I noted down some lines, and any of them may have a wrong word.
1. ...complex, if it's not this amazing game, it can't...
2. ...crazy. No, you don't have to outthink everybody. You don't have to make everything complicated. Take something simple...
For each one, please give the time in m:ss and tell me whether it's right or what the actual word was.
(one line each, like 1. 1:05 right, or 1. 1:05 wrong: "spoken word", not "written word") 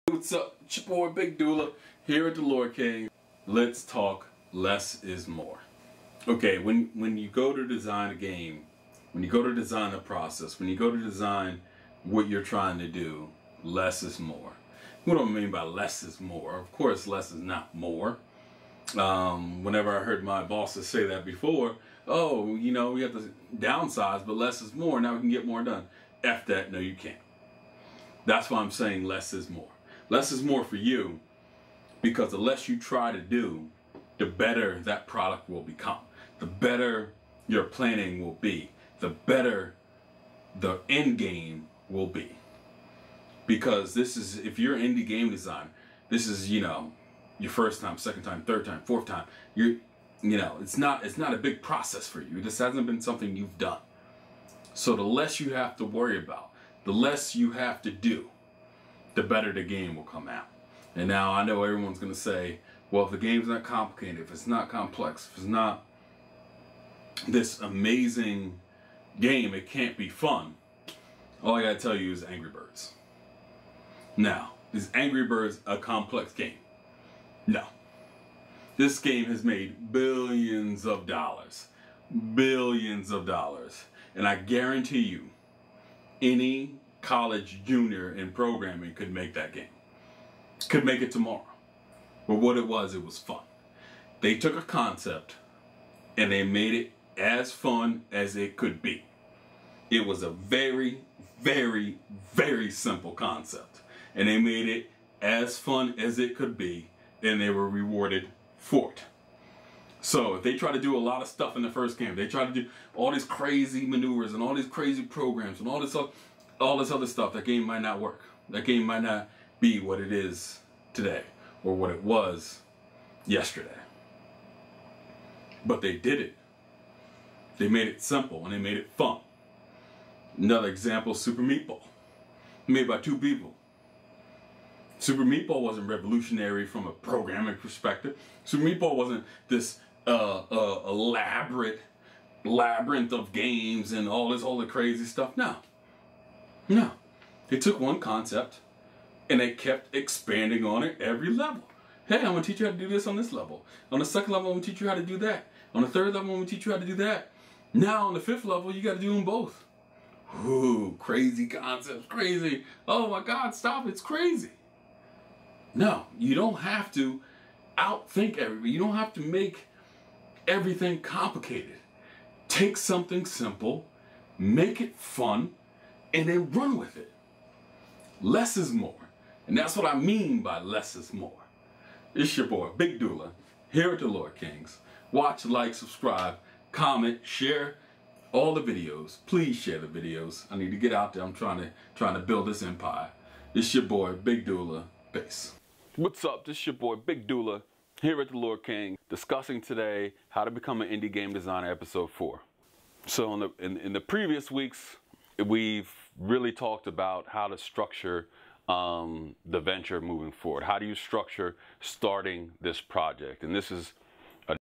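1. 1:04 right
2. 2:44 right.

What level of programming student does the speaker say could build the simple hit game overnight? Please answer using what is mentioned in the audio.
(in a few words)
college junior.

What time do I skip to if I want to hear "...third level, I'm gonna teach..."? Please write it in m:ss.
2:35.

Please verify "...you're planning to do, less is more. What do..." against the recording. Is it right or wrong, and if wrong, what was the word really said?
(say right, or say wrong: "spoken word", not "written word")
wrong: "trying", not "planning".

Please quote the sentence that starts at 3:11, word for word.
I'm trying to trying to build this empire.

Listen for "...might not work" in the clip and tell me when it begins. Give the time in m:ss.
1:57.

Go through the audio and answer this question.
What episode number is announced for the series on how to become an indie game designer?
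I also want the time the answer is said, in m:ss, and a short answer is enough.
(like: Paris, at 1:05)
4, at 3:21.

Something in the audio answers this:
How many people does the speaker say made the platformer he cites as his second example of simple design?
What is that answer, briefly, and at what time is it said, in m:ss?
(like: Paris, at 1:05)
2, at 2:12.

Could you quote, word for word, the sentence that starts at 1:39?
It was a very, very, very simple concept.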